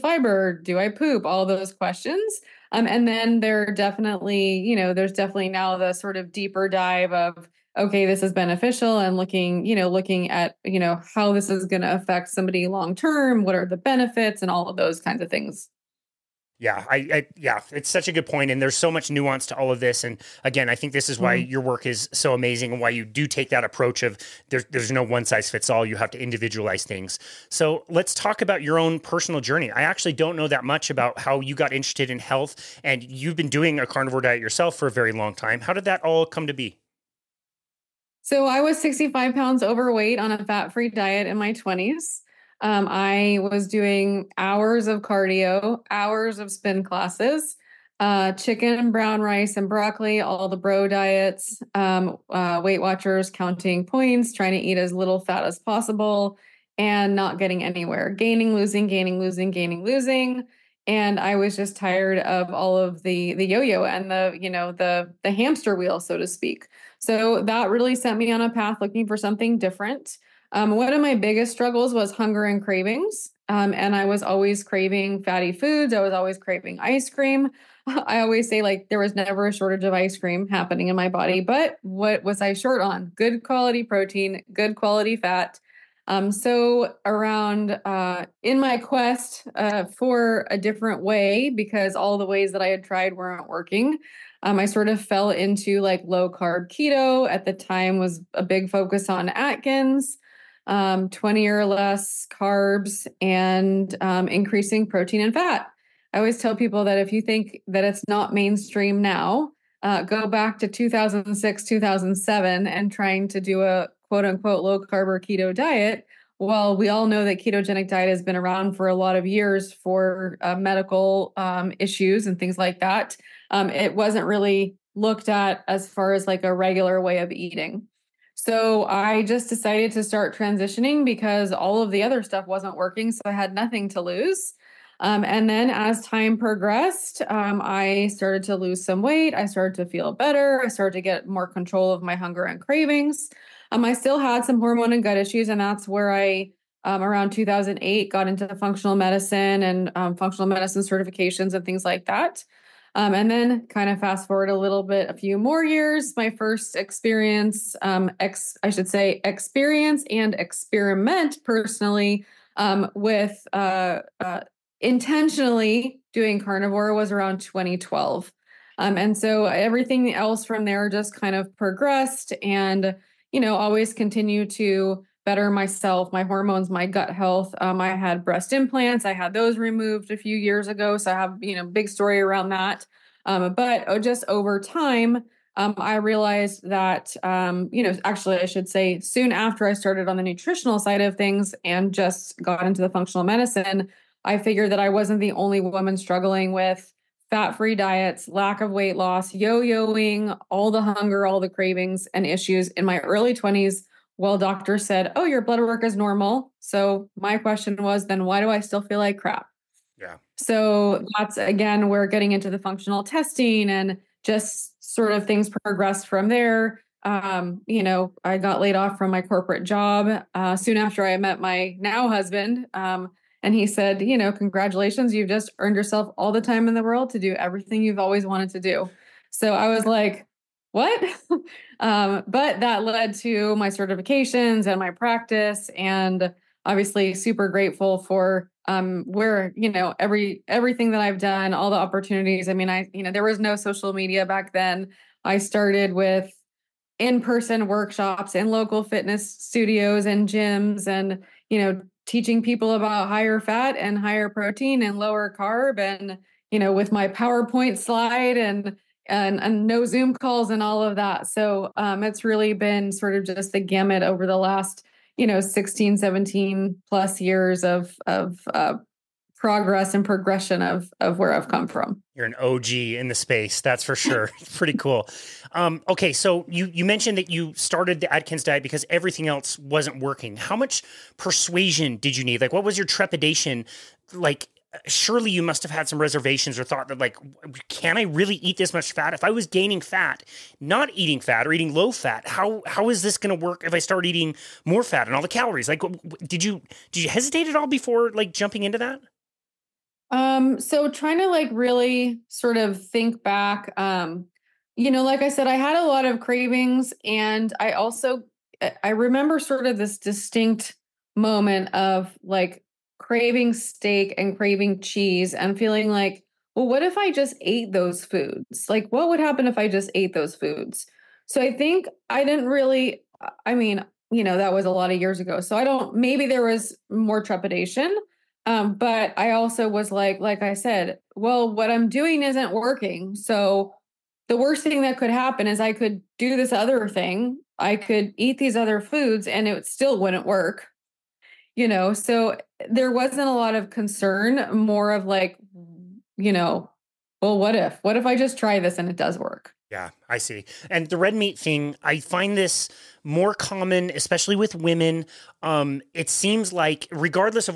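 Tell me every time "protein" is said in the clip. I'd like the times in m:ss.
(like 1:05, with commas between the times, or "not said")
1:23, 1:44, 4:14.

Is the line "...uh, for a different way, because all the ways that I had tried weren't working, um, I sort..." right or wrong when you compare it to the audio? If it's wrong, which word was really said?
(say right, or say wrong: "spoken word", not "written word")
right.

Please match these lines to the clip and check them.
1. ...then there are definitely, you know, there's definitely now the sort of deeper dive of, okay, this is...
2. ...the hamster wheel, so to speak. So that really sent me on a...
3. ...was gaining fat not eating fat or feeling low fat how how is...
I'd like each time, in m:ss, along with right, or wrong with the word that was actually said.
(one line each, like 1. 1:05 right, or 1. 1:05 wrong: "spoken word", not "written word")
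1. 0:03 right
2. 1:05 right
3. 4:49 wrong: "eating", not "feeling".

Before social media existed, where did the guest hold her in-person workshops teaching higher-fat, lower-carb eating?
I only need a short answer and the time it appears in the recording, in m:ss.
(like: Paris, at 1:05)
Local fitness studios and gyms, at 4:08.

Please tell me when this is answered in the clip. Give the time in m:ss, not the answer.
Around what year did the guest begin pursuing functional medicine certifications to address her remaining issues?
2:27.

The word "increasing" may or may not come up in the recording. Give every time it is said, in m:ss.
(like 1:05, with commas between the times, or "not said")
1:44.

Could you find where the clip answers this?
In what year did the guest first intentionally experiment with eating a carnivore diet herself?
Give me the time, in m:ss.
2:47.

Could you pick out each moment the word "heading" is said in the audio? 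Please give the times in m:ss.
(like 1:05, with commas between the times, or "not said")
not said.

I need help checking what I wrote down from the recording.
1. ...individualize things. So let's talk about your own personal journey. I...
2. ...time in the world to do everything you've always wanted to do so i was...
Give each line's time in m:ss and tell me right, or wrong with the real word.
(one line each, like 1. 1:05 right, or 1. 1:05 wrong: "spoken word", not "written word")
1. 0:26 right
2. 3:46 right.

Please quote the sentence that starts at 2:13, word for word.
So I had nothing to lose.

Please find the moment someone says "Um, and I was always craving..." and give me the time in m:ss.
1:13.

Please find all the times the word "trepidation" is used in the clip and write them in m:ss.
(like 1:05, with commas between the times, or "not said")
4:42, 5:27.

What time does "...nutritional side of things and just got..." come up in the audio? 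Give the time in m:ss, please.
3:10.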